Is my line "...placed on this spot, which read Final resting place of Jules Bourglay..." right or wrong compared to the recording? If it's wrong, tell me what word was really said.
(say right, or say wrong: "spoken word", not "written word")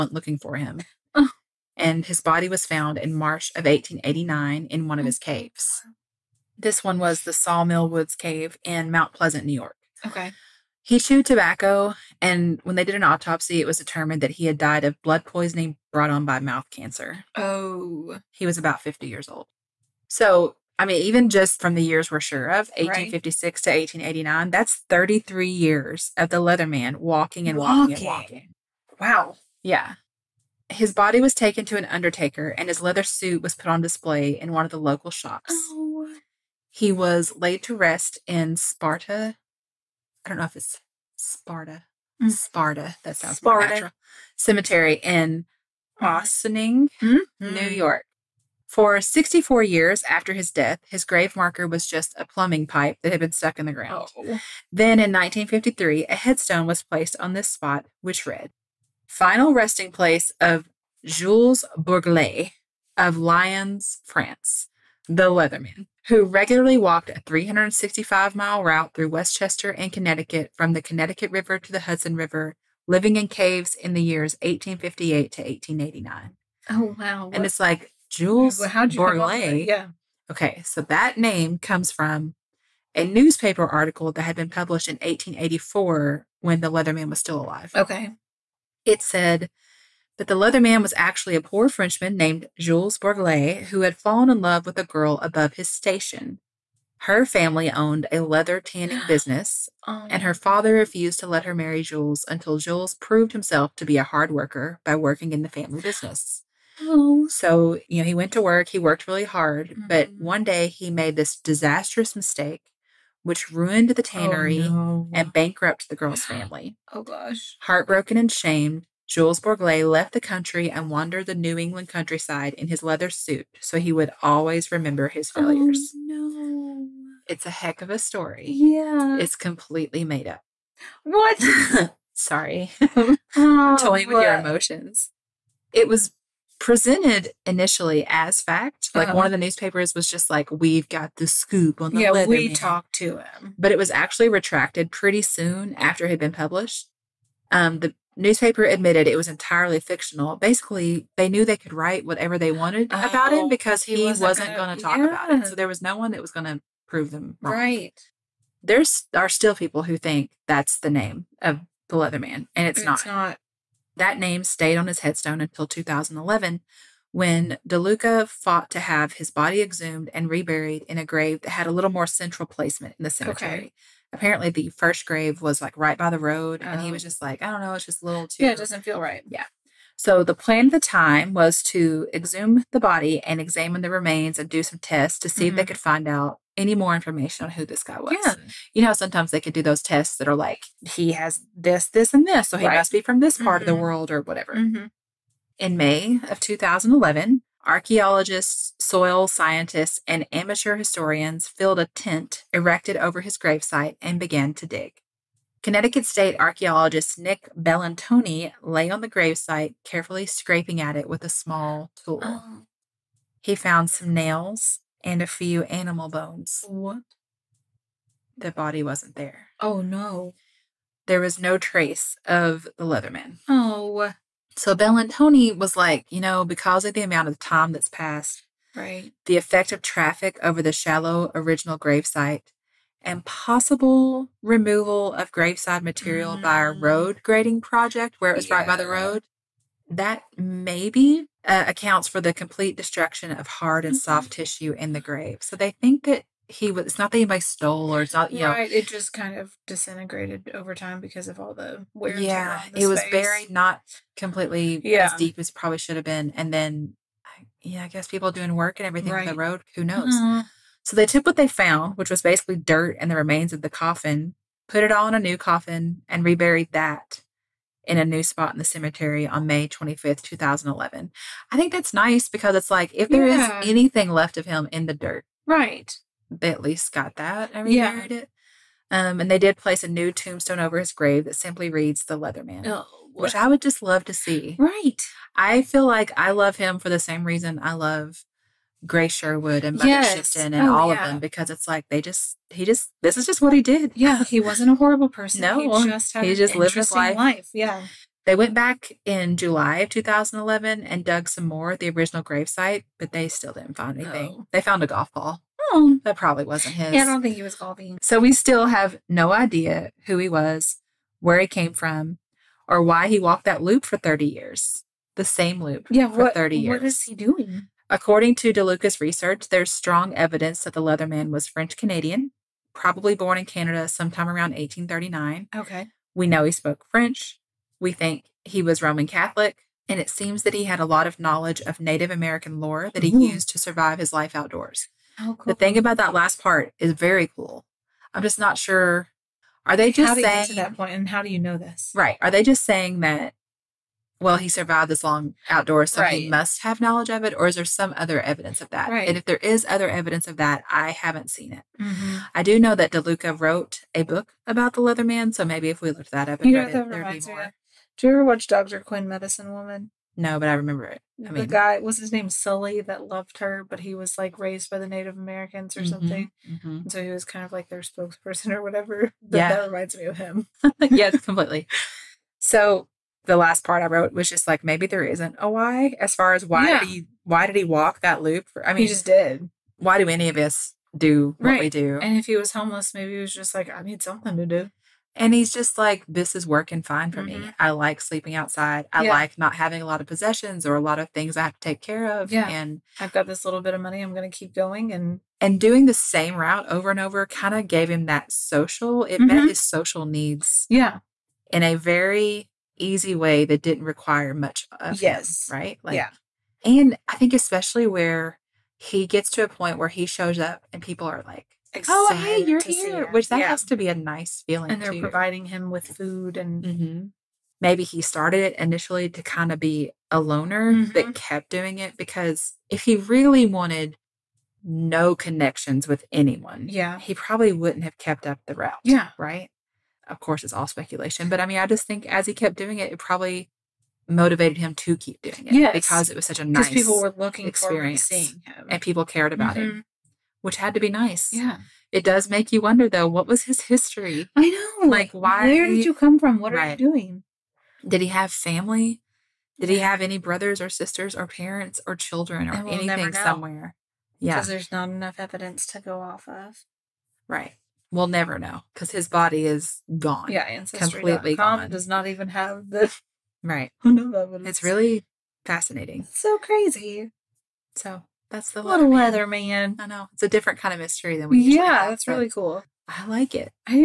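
right.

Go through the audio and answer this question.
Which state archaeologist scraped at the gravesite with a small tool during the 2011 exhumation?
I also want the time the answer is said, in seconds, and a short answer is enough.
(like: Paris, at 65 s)
Nick Bellantoni, at 207 s.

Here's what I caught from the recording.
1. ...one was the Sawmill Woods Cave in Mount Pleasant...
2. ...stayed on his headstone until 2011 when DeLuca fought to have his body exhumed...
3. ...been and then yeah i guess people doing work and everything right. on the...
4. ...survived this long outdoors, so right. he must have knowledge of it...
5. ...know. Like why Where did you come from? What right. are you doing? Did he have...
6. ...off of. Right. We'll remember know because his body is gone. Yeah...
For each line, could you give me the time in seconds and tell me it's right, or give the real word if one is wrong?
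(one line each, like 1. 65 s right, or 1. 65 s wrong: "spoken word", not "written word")
1. 6 s right
2. 164 s right
3. 256 s right
4. 344 s right
5. 444 s right
6. 456 s wrong: "never", not "remember".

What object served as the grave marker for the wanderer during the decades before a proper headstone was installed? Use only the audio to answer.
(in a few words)
a plumbing pipe.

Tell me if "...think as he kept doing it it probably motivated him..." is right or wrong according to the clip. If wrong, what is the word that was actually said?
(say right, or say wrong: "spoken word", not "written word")
right.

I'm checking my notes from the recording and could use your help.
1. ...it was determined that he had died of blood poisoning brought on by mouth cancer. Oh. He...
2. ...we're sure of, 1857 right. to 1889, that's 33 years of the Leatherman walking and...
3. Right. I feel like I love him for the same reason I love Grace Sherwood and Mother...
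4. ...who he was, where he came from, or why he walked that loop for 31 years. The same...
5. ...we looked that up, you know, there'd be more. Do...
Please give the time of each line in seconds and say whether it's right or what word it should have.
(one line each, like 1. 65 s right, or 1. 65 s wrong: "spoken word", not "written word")
1. 13 s right
2. 22 s wrong: "1856", not "1857"
3. 284 s right
4. 310 s wrong: "30", not "31"
5. 355 s right.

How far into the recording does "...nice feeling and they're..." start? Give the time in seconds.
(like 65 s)
413 s.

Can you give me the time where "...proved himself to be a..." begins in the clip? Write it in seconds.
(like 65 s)
102 s.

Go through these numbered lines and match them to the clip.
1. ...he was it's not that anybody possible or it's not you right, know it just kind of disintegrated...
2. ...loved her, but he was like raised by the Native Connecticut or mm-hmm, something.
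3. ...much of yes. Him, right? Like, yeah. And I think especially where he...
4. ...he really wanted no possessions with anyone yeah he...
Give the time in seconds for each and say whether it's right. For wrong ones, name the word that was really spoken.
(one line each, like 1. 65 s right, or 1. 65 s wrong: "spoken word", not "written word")
1. 246 s wrong: "stole", not "possible"
2. 363 s wrong: "Americans", not "Connecticut"
3. 404 s right
4. 422 s wrong: "connections", not "possessions".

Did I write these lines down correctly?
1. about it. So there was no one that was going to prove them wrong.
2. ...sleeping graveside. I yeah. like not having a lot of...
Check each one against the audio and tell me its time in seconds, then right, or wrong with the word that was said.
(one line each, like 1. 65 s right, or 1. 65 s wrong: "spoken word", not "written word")
1. 155 s right
2. 388 s wrong: "outside", not "graveside".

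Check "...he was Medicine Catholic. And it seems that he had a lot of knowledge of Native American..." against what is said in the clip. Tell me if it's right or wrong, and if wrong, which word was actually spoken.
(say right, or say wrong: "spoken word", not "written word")
wrong: "Roman", not "Medicine".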